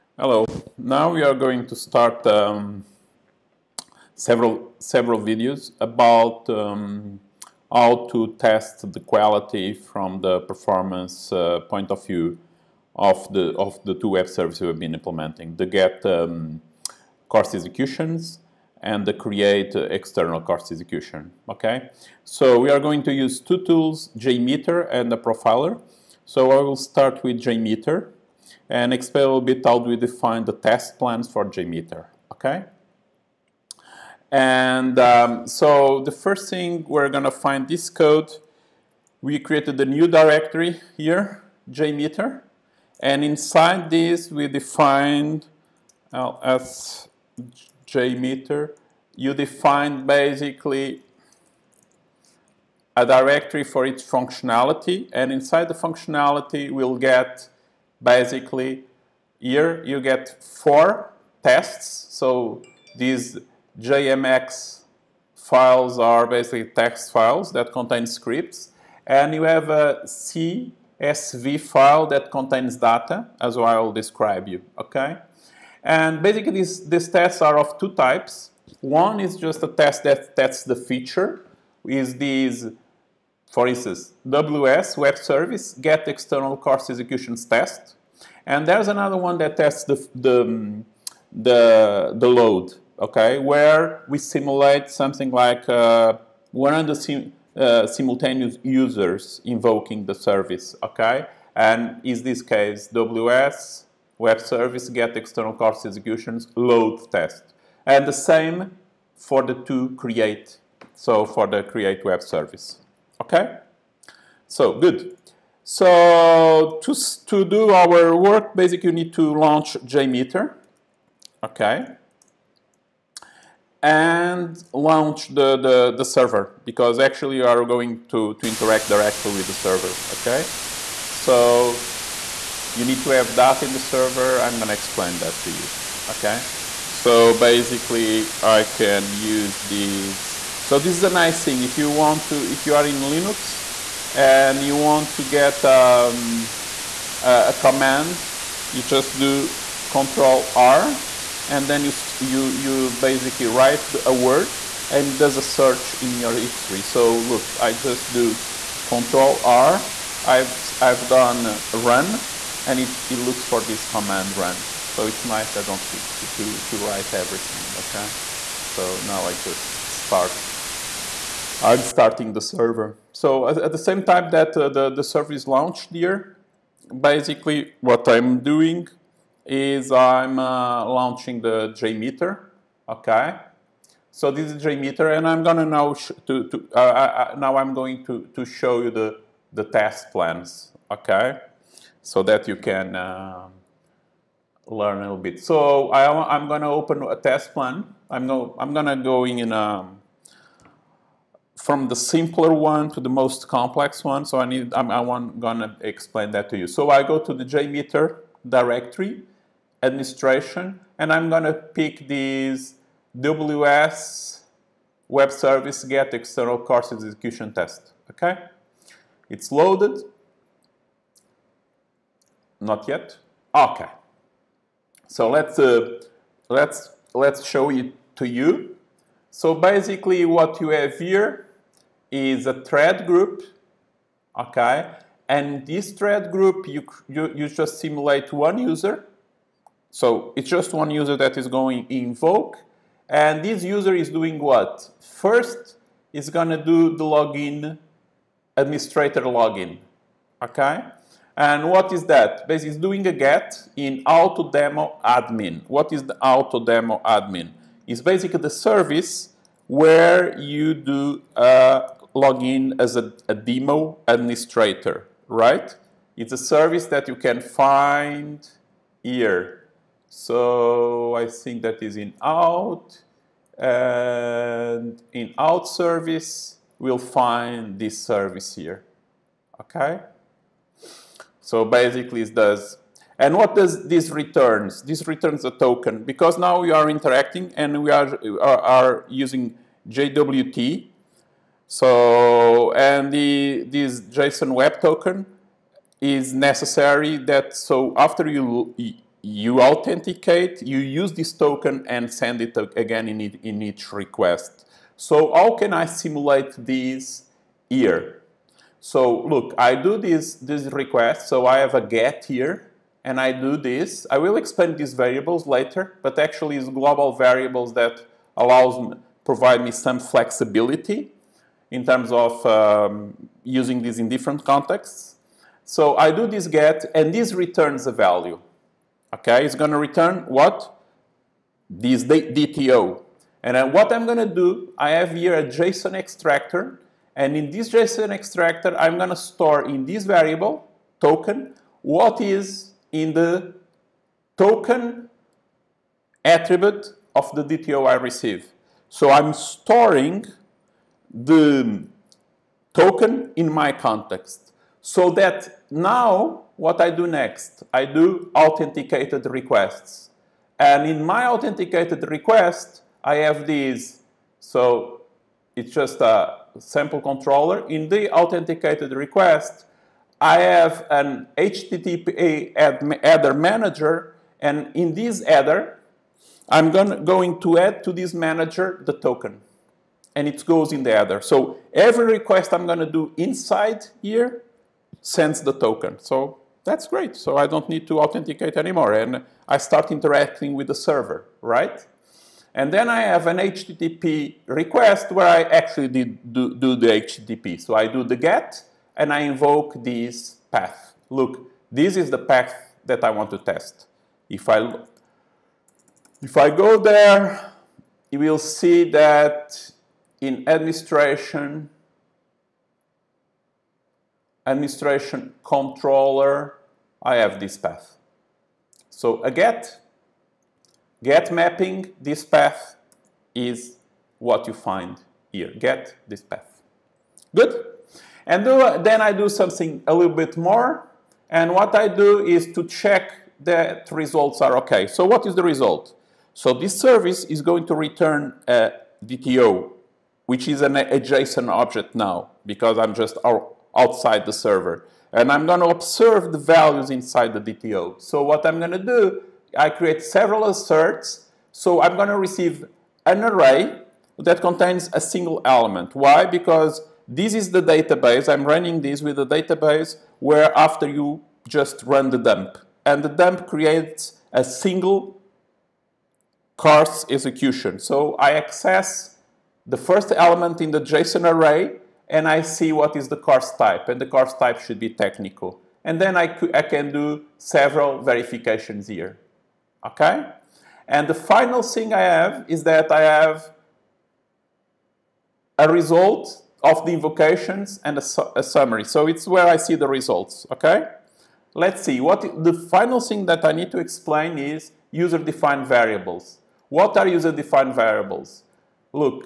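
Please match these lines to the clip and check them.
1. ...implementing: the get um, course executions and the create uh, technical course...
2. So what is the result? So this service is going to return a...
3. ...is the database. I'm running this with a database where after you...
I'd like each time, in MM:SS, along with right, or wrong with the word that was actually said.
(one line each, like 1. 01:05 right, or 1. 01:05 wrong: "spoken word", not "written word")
1. 00:14 wrong: "external", not "technical"
2. 07:14 right
3. 07:37 right.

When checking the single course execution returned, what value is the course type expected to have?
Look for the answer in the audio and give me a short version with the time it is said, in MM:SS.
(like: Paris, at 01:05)
technical, at 07:54.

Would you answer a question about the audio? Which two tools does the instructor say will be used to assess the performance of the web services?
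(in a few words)
JMeter and the Profiler.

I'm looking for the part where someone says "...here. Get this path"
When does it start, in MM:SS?
07:05.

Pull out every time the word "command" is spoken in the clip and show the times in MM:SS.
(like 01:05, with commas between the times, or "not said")
02:27, 02:43.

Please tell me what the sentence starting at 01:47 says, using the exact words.
And the same for the two create, so for the create web service, okay?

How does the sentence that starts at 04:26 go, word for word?
It's a service that you can find here.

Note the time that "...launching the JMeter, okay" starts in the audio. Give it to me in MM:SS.
03:00.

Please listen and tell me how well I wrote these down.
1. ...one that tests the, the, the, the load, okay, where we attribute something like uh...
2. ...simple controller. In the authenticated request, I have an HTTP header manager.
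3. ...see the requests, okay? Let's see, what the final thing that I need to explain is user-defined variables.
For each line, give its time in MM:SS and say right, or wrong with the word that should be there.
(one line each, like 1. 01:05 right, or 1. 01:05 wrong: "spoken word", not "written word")
1. 01:29 wrong: "simulate", not "attribute"
2. 06:06 right
3. 08:09 wrong: "results", not "requests".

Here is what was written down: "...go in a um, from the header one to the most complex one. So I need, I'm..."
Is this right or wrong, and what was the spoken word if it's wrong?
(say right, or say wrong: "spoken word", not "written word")
wrong: "simpler", not "header".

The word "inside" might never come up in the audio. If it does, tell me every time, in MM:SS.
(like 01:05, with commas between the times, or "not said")
00:43, 00:55, 06:23, 07:26.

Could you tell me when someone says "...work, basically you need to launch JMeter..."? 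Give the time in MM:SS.
01:58.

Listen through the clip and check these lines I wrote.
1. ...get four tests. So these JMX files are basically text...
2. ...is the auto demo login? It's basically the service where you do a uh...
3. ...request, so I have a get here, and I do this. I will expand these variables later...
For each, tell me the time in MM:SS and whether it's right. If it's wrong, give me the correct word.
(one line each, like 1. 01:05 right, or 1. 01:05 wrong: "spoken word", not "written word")
1. 00:59 right
2. 04:15 wrong: "admin", not "login"
3. 05:10 right.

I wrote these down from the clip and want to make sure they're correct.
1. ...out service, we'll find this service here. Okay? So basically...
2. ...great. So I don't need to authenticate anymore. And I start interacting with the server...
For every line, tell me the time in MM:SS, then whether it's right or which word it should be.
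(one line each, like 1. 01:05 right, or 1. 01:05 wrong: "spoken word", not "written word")
1. 04:35 right
2. 06:26 right.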